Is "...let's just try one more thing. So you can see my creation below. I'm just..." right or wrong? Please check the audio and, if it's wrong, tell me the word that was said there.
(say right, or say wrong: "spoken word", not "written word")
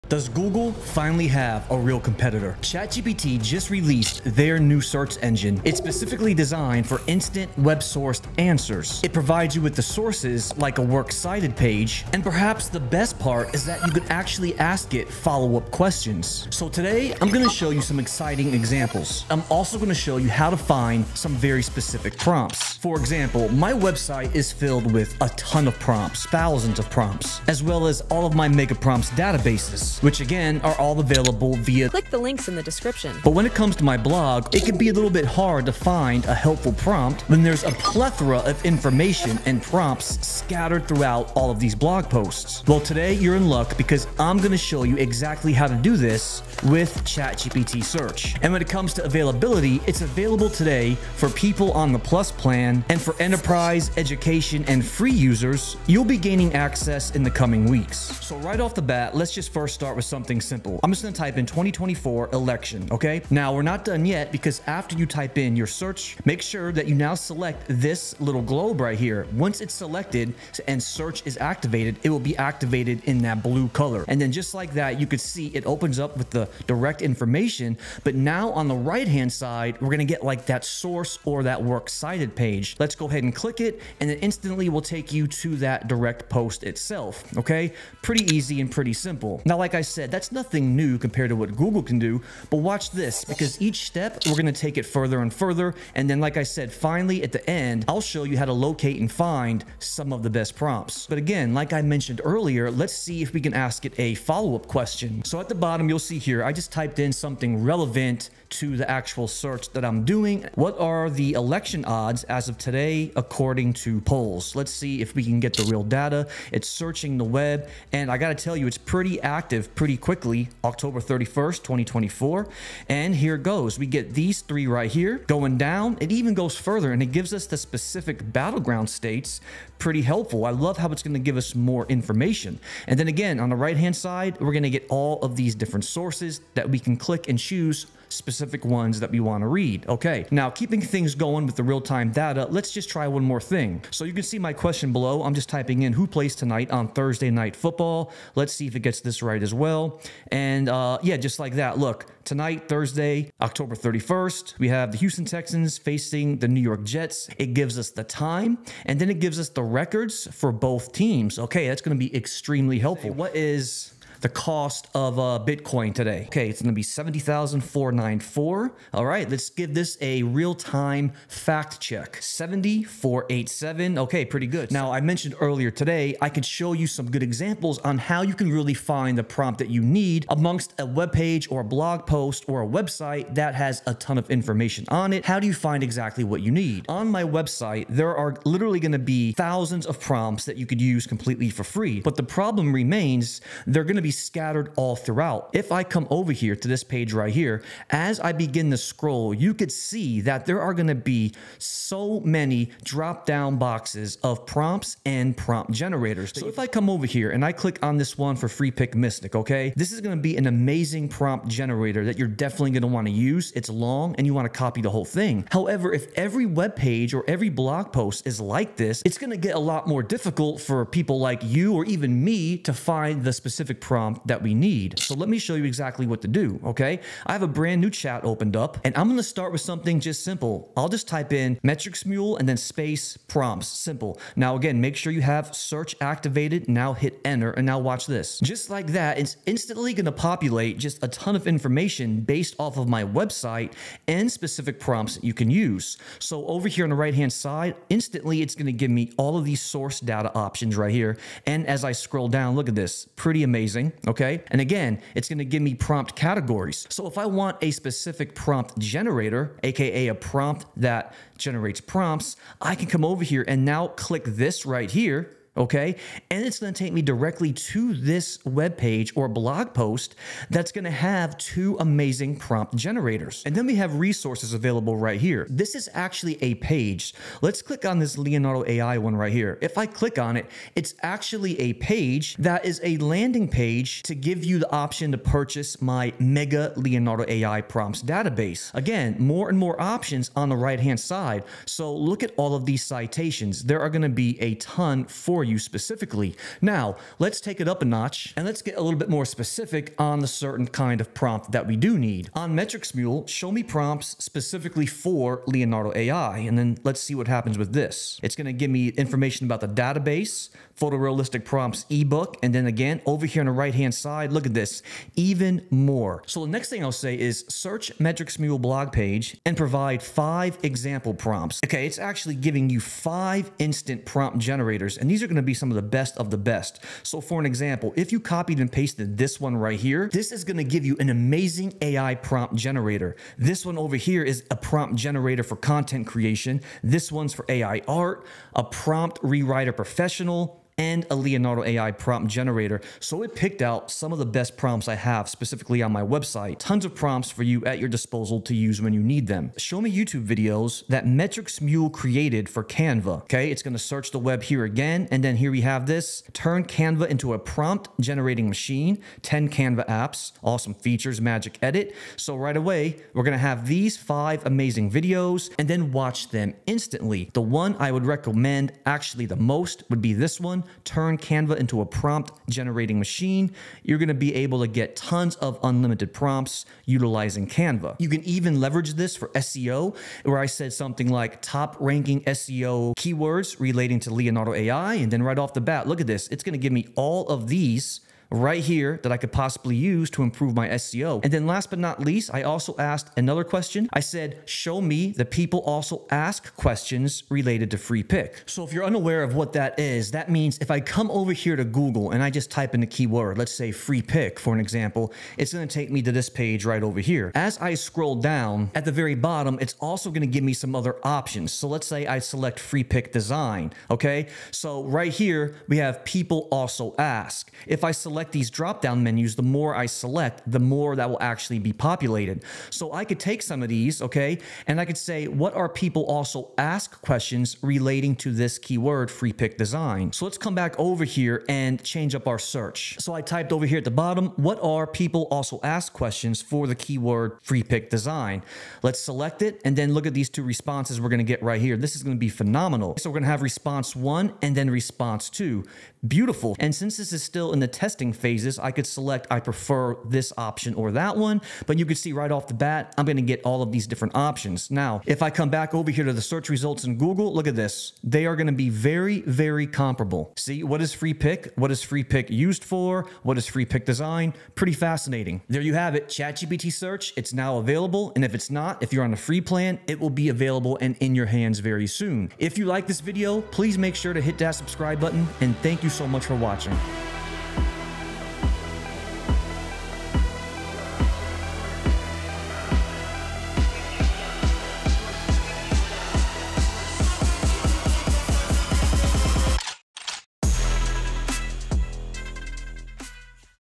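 wrong: "question", not "creation".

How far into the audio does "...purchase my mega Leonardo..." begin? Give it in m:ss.
4:45.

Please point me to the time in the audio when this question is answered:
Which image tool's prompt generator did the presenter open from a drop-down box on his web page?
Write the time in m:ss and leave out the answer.
3:28.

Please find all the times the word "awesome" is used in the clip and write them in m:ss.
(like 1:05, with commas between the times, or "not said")
6:00.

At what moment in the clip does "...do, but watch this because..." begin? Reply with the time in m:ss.
1:31.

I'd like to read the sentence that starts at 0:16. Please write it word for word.
So today, I'm gonna show you some exciting examples.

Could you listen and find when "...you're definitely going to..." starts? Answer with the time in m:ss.
3:32.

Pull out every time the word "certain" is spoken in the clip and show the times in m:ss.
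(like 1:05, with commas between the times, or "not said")
5:00.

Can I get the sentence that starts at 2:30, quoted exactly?
And uh, yeah, just like that.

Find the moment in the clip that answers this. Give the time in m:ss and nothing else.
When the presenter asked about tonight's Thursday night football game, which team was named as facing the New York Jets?
2:34.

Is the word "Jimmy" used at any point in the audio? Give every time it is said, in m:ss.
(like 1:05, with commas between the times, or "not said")
not said.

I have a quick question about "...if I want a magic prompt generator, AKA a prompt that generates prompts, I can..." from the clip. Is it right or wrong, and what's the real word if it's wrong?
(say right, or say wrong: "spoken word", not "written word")
wrong: "specific", not "magic".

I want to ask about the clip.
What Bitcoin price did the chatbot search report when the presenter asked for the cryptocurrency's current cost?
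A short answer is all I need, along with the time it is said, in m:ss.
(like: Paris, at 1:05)
70,494, at 2:46.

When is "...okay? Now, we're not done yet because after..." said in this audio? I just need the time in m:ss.
1:02.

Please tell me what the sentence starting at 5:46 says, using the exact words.
Tons of prompts for you at your disposal to use when you need them.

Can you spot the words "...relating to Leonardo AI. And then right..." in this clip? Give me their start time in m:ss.
6:23.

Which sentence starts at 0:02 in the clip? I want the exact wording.
ChatGPT just released their new search engine.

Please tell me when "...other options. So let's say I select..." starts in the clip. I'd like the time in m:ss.
6:50.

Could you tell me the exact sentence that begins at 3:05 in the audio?
How do you find exactly what you need?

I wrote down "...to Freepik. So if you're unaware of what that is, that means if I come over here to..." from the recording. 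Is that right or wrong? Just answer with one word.
right.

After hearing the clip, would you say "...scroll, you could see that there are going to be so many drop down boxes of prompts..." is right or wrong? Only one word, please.
right.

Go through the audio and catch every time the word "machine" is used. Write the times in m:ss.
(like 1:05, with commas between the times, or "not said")
5:58, 6:12.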